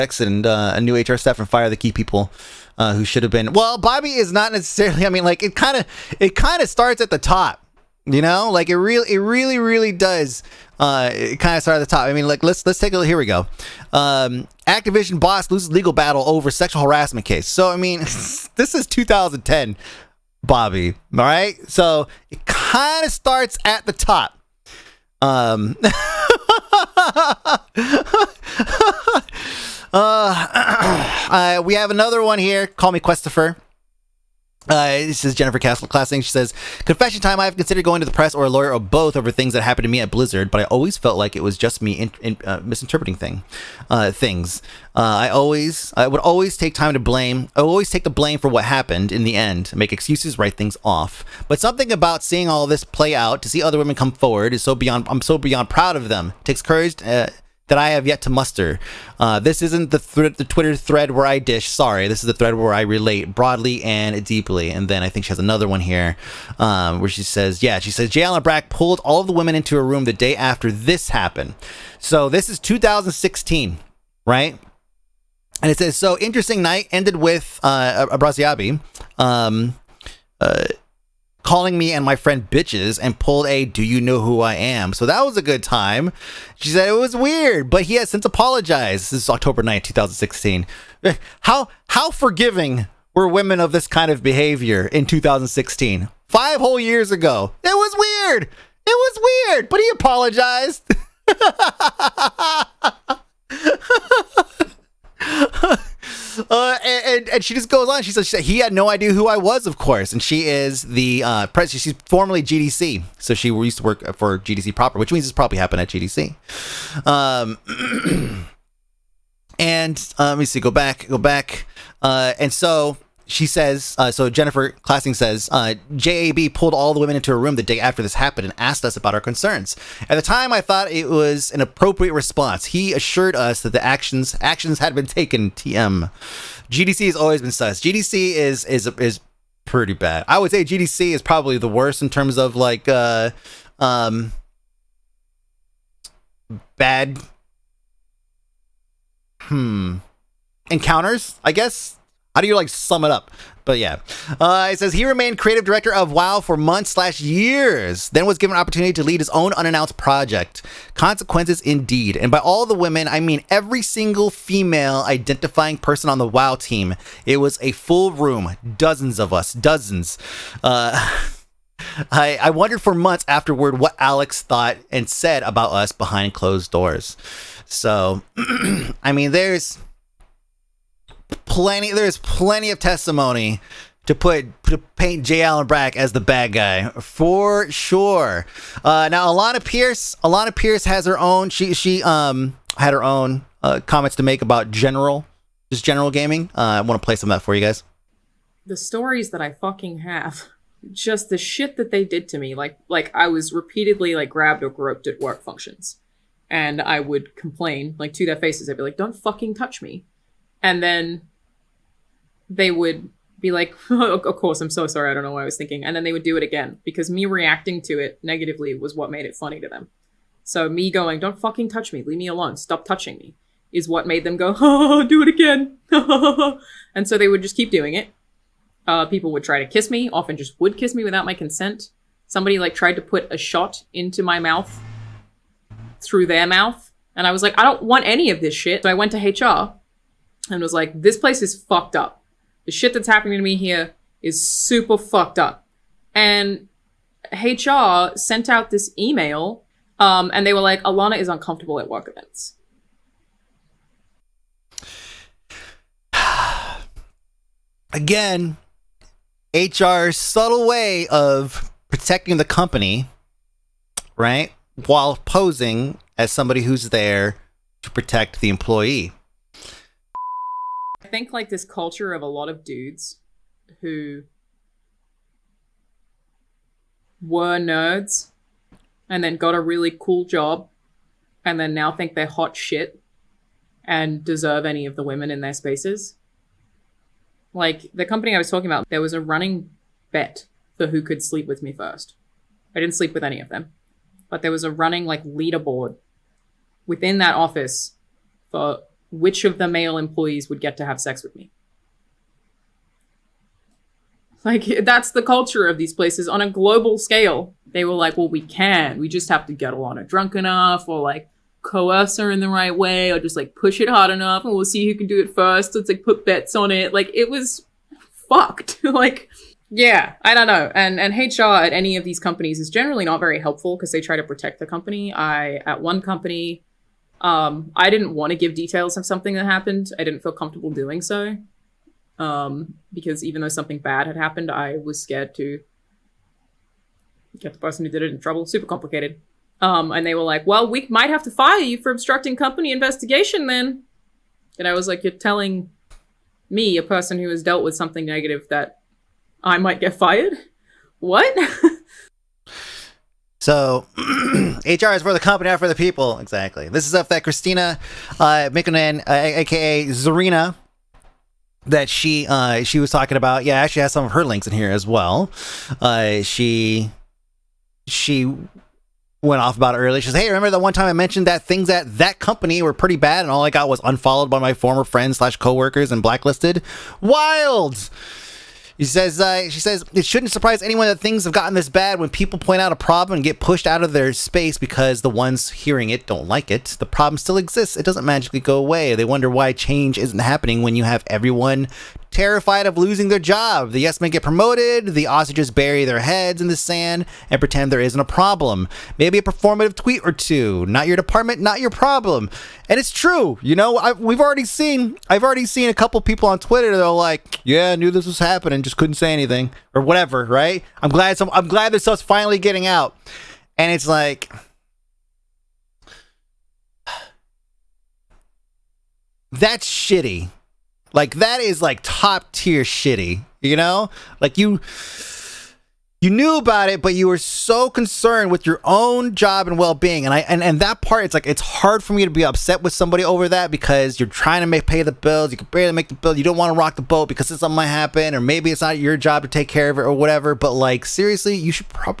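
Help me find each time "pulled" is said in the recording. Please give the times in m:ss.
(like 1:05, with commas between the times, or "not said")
1:08, 1:23, 2:06.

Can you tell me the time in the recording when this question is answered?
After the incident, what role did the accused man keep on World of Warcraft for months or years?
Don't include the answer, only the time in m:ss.
2:35.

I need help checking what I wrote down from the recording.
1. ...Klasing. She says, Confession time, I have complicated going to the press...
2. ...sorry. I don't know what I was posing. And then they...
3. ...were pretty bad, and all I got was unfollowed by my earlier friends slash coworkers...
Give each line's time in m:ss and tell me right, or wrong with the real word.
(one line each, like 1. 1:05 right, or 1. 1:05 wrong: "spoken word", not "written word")
1. 0:35 wrong: "considered", not "complicated"
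2. 3:34 wrong: "thinking", not "posing"
3. 6:12 wrong: "former", not "earlier".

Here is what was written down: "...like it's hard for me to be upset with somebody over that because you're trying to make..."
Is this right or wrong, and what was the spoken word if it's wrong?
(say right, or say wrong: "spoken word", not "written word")
right.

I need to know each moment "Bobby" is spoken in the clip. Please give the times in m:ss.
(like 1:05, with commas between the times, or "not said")
0:03, 0:20.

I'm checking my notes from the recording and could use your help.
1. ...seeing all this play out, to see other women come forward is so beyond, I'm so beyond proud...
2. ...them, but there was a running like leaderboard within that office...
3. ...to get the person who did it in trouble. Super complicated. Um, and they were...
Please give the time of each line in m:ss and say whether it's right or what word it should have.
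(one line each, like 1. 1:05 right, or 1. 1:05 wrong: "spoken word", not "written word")
1. 0:52 right
2. 4:53 right
3. 5:35 right.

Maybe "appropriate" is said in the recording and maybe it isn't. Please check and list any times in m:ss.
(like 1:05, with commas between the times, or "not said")
2:11.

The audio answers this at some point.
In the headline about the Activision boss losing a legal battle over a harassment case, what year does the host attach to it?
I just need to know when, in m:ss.
0:18.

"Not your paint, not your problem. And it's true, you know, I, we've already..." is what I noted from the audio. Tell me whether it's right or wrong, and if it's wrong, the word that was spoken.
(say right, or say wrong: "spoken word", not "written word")
wrong: "department", not "paint".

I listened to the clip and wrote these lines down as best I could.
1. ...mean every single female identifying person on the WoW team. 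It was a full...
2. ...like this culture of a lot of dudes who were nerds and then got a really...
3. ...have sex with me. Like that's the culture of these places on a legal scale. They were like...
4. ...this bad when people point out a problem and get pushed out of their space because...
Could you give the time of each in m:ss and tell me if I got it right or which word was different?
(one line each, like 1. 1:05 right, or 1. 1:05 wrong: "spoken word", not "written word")
1. 2:43 right
2. 4:31 right
3. 5:00 wrong: "global", not "legal"
4. 6:21 right.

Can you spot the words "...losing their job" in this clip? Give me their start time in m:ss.
6:32.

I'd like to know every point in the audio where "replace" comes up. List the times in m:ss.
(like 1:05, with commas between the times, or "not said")
not said.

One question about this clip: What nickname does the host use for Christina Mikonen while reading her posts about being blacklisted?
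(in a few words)
Zarina.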